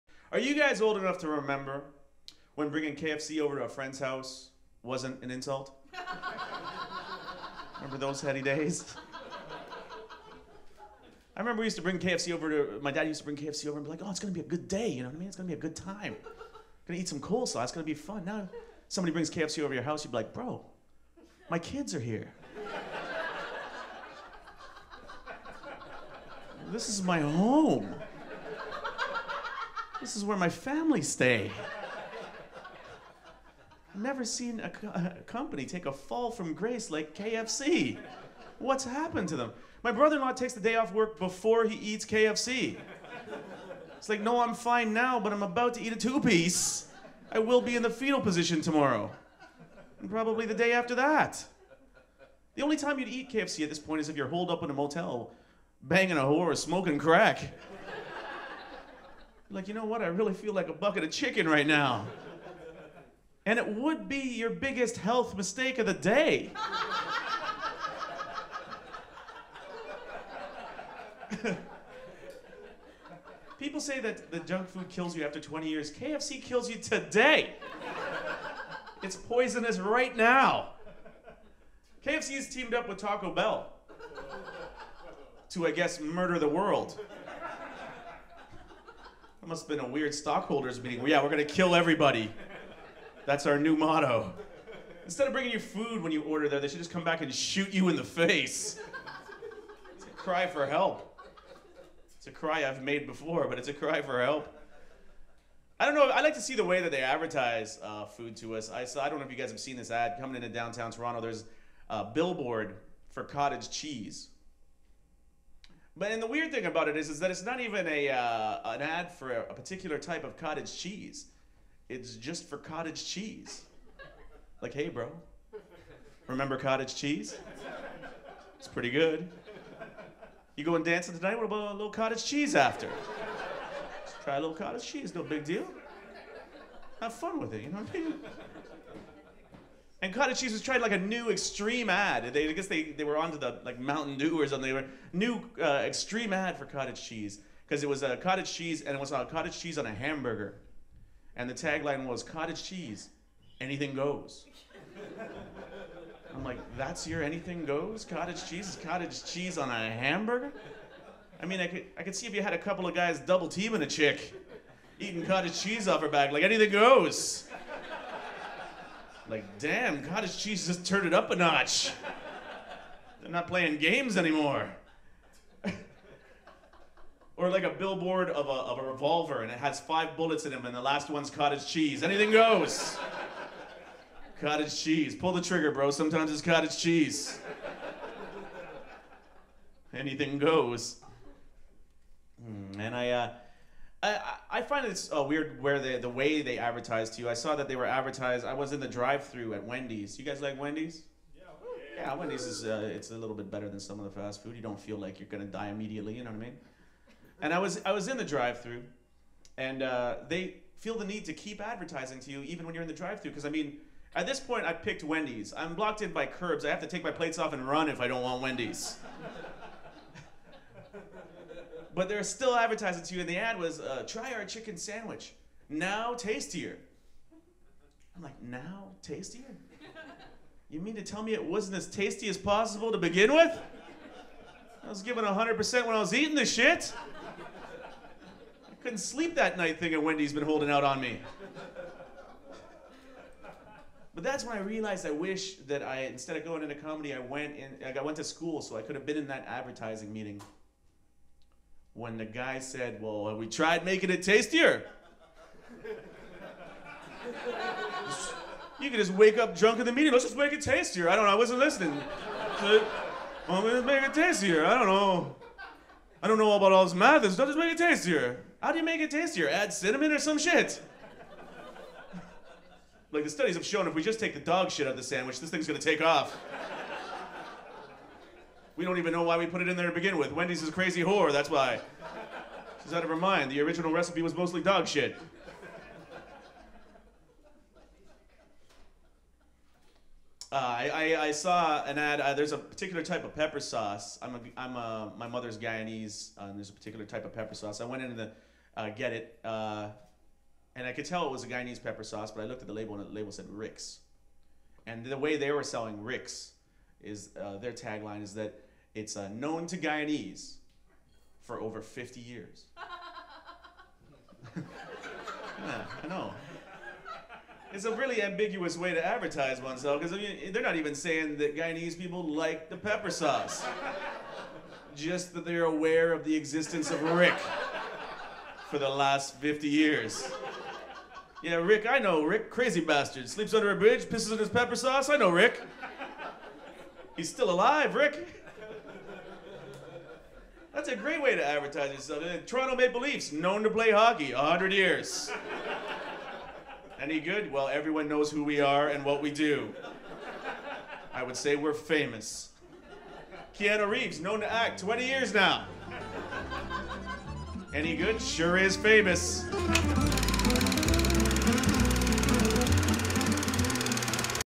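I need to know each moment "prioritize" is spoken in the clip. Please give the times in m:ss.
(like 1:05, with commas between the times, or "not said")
not said.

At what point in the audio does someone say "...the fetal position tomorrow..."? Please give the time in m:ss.
0:47.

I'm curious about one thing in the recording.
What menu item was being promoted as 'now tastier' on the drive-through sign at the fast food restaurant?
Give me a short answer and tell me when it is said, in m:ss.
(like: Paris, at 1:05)
Chicken sandwich, at 3:44.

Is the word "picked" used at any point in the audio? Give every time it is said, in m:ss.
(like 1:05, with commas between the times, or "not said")
3:34.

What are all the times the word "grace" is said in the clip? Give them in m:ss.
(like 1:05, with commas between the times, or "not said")
0:36.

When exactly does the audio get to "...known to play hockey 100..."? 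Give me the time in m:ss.
5:43.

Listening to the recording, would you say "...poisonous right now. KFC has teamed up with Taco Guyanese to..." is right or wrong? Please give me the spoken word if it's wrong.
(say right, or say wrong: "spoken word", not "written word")
wrong: "Bell", not "Guyanese".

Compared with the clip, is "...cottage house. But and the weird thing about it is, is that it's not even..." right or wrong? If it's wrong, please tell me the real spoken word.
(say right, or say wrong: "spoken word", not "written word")
wrong: "cheese", not "house".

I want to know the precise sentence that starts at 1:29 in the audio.
That must have been a weird stockholders meeting.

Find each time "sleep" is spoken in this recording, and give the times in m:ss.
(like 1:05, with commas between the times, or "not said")
3:58, 5:33.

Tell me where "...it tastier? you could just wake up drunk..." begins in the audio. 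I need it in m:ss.
4:14.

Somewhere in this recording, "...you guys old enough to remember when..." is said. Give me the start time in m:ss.
0:00.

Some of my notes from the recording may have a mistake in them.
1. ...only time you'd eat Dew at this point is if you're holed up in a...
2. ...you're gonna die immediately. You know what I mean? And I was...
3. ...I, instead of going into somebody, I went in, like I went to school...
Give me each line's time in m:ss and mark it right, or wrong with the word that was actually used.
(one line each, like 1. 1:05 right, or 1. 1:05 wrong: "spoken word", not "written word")
1. 0:52 wrong: "KFC", not "Dew"
2. 3:25 right
3. 4:05 wrong: "comedy", not "somebody".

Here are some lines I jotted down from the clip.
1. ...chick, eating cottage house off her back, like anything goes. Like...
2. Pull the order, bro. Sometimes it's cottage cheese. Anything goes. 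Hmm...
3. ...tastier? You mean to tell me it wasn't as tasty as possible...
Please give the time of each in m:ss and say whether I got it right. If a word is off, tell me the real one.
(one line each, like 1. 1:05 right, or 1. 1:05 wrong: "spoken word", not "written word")
1. 2:43 wrong: "cheese", not "house"
2. 3:05 wrong: "trigger", not "order"
3. 3:49 right.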